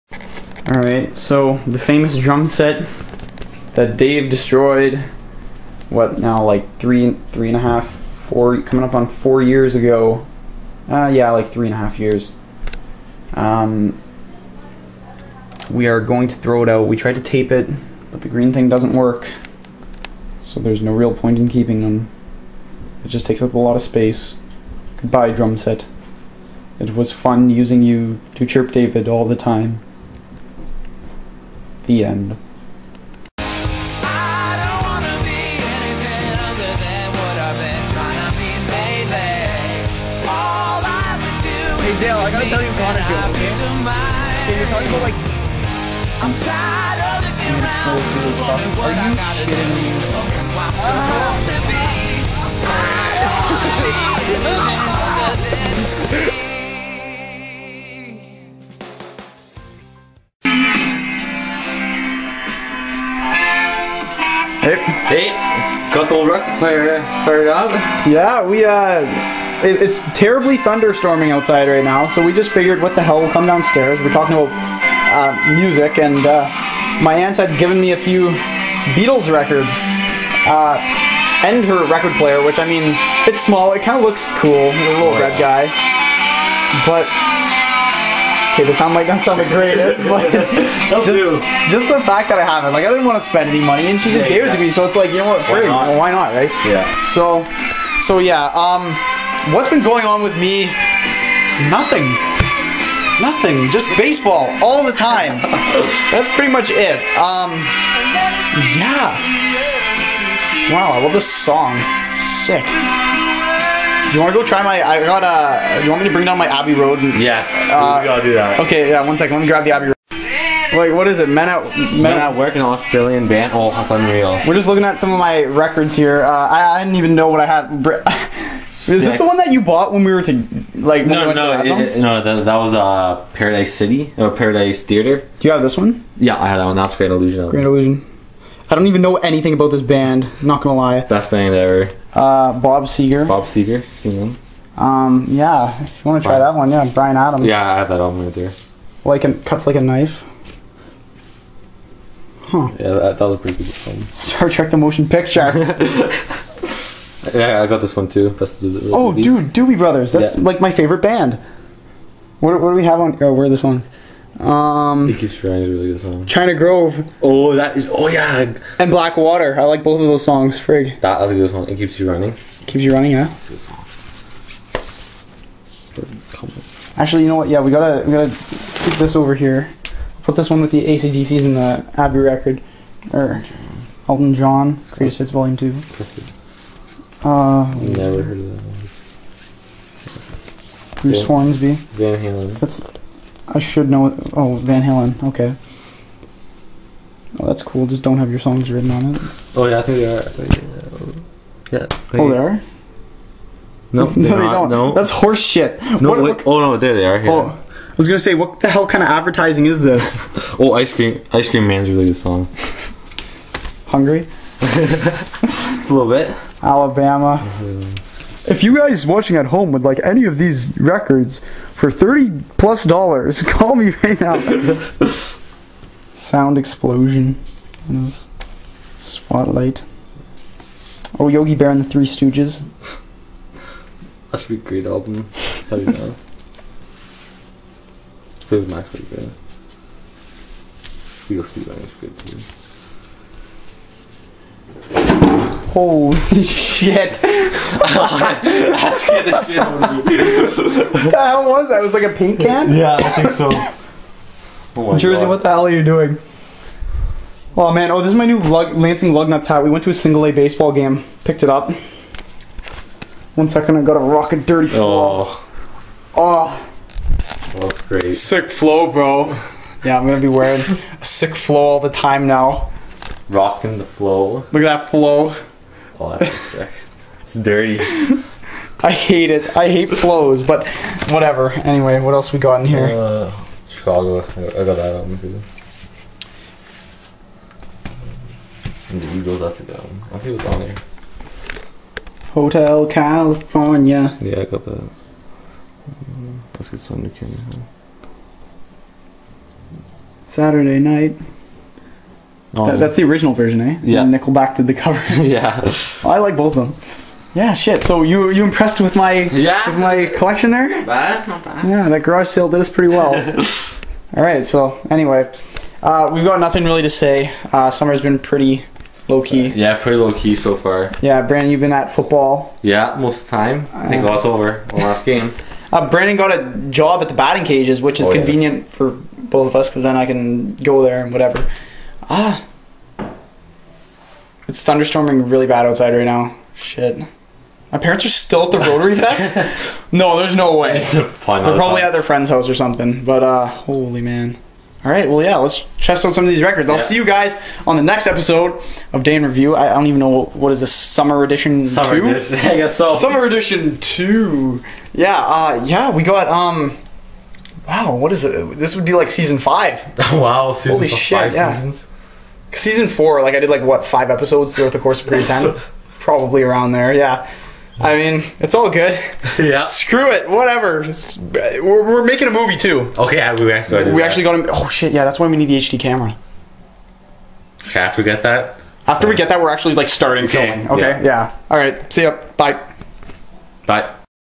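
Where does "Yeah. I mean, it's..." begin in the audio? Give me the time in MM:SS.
06:06.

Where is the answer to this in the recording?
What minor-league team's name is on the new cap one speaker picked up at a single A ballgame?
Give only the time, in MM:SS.
04:18.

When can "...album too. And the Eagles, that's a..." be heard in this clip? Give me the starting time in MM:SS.
04:44.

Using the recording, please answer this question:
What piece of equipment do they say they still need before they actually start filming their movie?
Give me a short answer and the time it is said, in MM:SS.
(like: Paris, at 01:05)
HD camera, at 06:15.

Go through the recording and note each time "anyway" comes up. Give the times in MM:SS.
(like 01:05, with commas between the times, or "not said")
04:41, 05:14.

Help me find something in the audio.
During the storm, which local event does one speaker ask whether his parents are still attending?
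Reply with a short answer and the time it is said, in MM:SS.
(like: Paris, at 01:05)
Rotary Fest, at 05:38.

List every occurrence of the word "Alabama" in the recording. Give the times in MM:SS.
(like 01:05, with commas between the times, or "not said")
03:36.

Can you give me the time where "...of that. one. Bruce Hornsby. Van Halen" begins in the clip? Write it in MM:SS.
03:08.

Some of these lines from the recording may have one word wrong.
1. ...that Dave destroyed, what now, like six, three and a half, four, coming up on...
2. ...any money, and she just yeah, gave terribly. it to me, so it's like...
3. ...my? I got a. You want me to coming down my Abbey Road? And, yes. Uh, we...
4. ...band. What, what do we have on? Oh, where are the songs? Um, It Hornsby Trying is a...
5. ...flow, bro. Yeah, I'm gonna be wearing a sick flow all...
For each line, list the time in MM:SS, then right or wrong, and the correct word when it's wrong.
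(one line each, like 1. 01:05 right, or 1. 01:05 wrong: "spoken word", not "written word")
1. 00:03 wrong: "three", not "six"
2. 01:33 wrong: "exactly", not "terribly"
3. 01:54 wrong: "bring", not "coming"
4. 02:41 wrong: "Keeps", not "Hornsby"
5. 04:28 right.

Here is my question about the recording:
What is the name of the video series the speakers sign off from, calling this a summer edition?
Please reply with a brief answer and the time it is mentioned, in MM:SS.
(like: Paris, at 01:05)
Day in Review, at 05:49.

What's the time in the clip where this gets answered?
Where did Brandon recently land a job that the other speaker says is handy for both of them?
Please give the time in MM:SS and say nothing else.
05:27.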